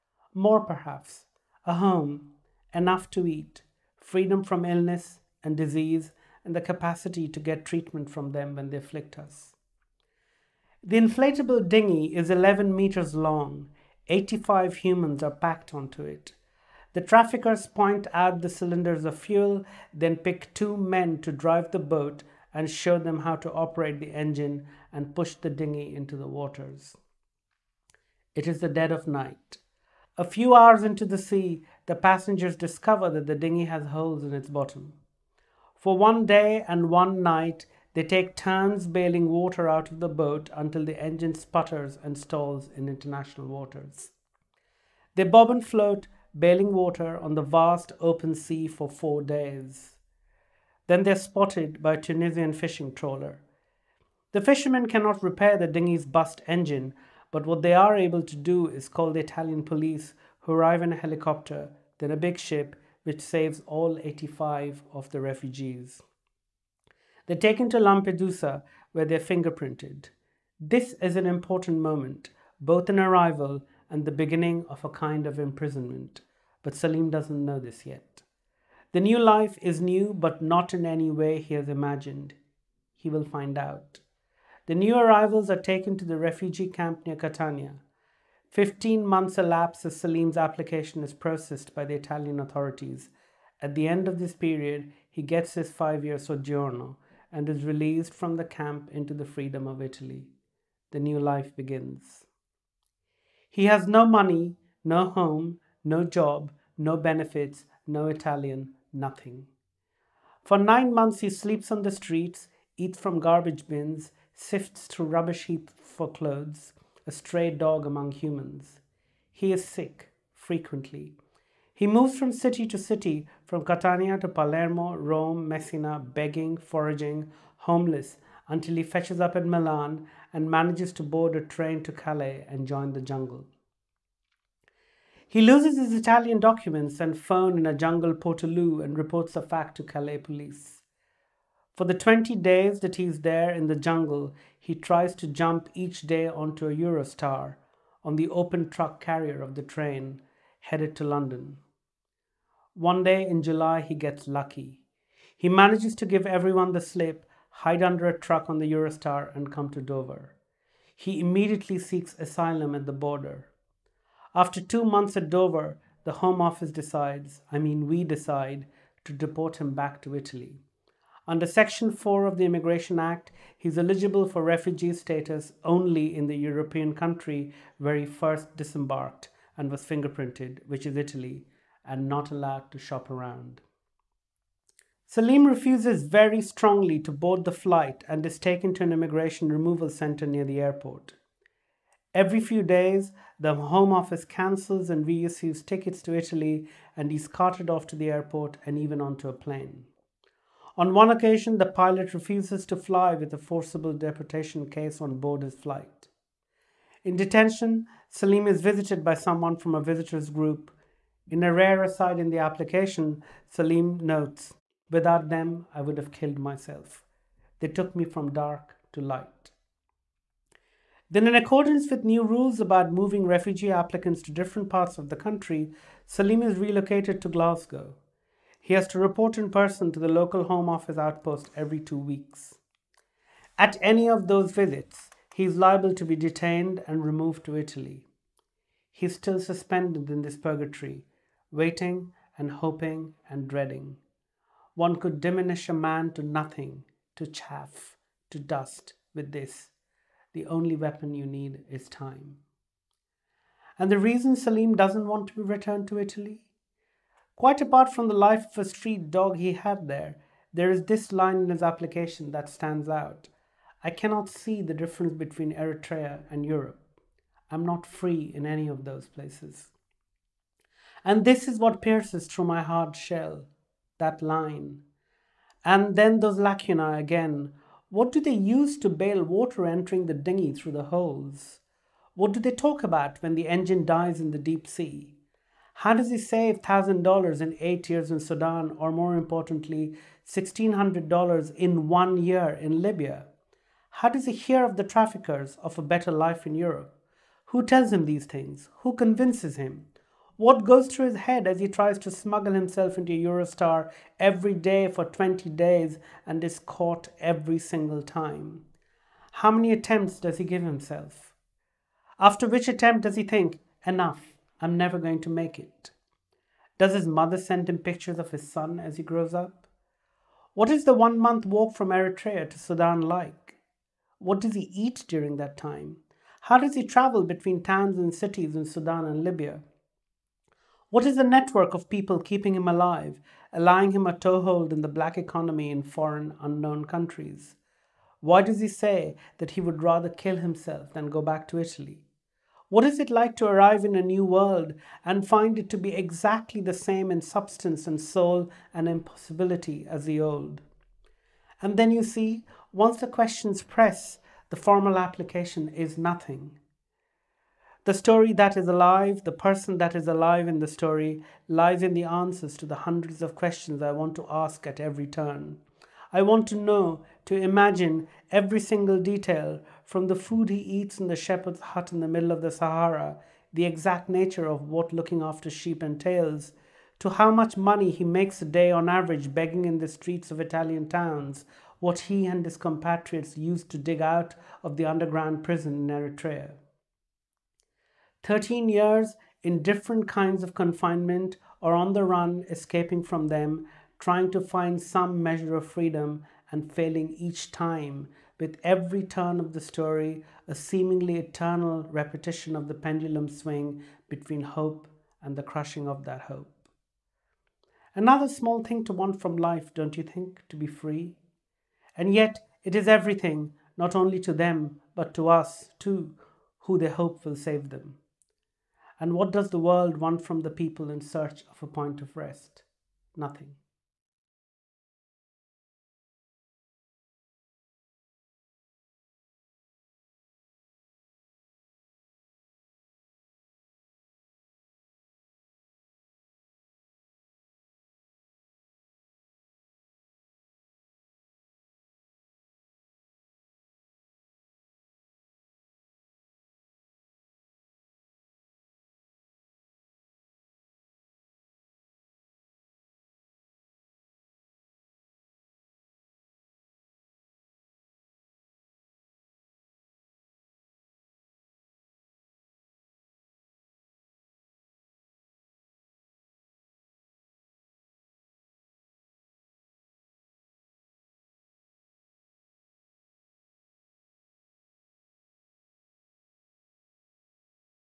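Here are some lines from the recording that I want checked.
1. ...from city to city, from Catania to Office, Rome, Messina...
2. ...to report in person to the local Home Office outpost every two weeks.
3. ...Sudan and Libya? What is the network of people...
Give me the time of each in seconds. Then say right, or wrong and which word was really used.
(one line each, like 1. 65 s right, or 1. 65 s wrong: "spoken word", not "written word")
1. 122 s wrong: "Palermo", not "Office"
2. 228 s right
3. 328 s right.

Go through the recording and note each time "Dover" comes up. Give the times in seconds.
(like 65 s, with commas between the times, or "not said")
159 s, 165 s.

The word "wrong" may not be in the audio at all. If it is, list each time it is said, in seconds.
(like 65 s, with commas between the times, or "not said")
not said.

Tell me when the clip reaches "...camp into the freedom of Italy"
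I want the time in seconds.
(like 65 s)
98 s.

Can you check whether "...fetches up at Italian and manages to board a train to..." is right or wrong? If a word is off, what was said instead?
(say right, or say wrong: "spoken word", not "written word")
wrong: "Milan", not "Italian".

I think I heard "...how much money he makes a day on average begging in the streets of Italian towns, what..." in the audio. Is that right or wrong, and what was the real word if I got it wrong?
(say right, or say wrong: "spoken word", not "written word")
right.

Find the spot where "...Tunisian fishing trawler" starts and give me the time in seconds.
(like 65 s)
52 s.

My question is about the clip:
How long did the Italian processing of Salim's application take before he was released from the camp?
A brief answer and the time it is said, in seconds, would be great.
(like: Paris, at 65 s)
15 months, at 88 s.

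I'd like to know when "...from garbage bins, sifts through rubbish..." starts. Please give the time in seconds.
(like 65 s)
112 s.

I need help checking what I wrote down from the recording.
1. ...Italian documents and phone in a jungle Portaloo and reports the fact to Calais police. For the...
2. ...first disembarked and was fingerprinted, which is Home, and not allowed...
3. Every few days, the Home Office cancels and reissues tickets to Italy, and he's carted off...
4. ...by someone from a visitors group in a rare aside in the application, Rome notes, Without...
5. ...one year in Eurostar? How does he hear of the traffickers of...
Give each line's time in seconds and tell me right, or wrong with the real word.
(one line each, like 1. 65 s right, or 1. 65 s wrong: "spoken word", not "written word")
1. 135 s right
2. 178 s wrong: "Italy", not "Home"
3. 192 s right
4. 209 s wrong: "Salim", not "Rome"
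5. 291 s wrong: "Libya", not "Eurostar".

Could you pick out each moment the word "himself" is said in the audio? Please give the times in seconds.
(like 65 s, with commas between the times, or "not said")
302 s, 310 s, 340 s.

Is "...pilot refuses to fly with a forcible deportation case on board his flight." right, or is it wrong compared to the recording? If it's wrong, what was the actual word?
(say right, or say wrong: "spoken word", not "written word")
right.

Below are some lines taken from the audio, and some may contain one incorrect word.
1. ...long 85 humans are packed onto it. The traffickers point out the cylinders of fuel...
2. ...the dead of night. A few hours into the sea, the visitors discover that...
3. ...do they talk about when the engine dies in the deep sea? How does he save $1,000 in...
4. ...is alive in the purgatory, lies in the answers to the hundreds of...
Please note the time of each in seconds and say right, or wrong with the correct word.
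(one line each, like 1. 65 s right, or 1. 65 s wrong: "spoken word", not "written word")
1. 13 s right
2. 28 s wrong: "passengers", not "visitors"
3. 282 s right
4. 359 s wrong: "story", not "purgatory".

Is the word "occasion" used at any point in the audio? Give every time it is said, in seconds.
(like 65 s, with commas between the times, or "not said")
201 s.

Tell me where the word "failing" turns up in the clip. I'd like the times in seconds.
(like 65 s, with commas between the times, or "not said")
396 s.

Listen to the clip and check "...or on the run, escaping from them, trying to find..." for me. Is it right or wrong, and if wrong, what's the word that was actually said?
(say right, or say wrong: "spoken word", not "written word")
right.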